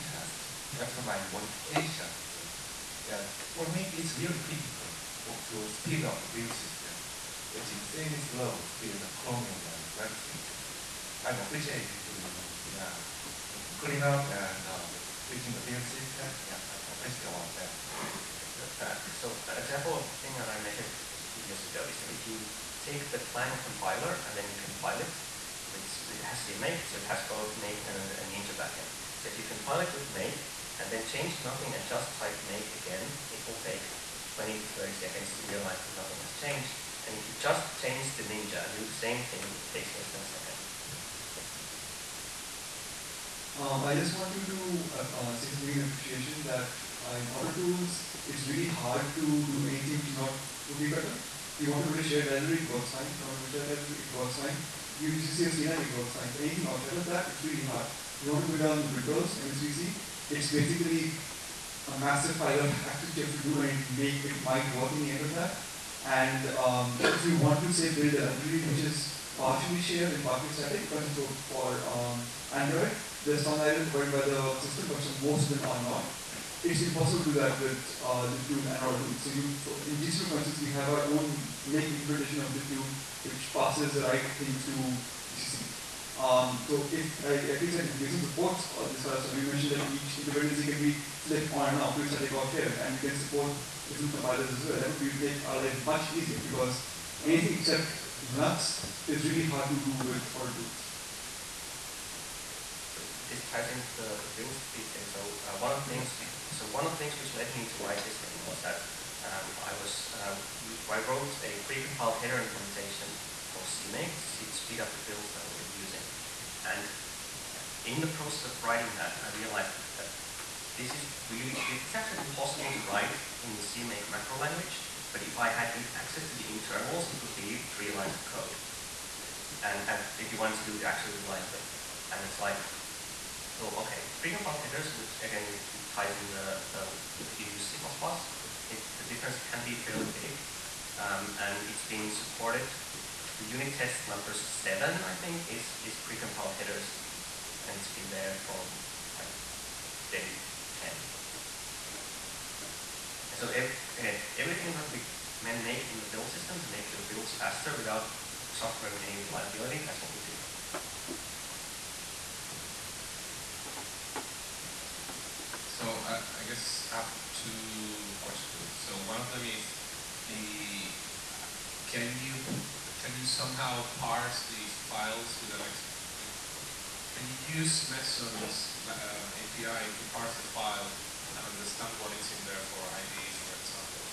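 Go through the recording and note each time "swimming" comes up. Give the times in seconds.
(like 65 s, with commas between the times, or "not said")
not said.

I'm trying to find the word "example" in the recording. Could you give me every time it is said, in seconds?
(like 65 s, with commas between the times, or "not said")
19 s, 183 s.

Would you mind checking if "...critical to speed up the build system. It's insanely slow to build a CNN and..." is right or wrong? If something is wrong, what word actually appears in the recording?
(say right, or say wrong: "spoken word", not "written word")
wrong: "Chromium", not "CNN".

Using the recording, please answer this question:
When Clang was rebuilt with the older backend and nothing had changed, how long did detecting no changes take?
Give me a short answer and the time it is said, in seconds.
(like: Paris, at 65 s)
20 to 30 seconds, at 34 s.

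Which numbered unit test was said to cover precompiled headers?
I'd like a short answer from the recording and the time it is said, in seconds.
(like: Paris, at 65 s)
7, at 144 s.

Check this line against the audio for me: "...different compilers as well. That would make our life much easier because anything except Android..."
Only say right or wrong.
wrong.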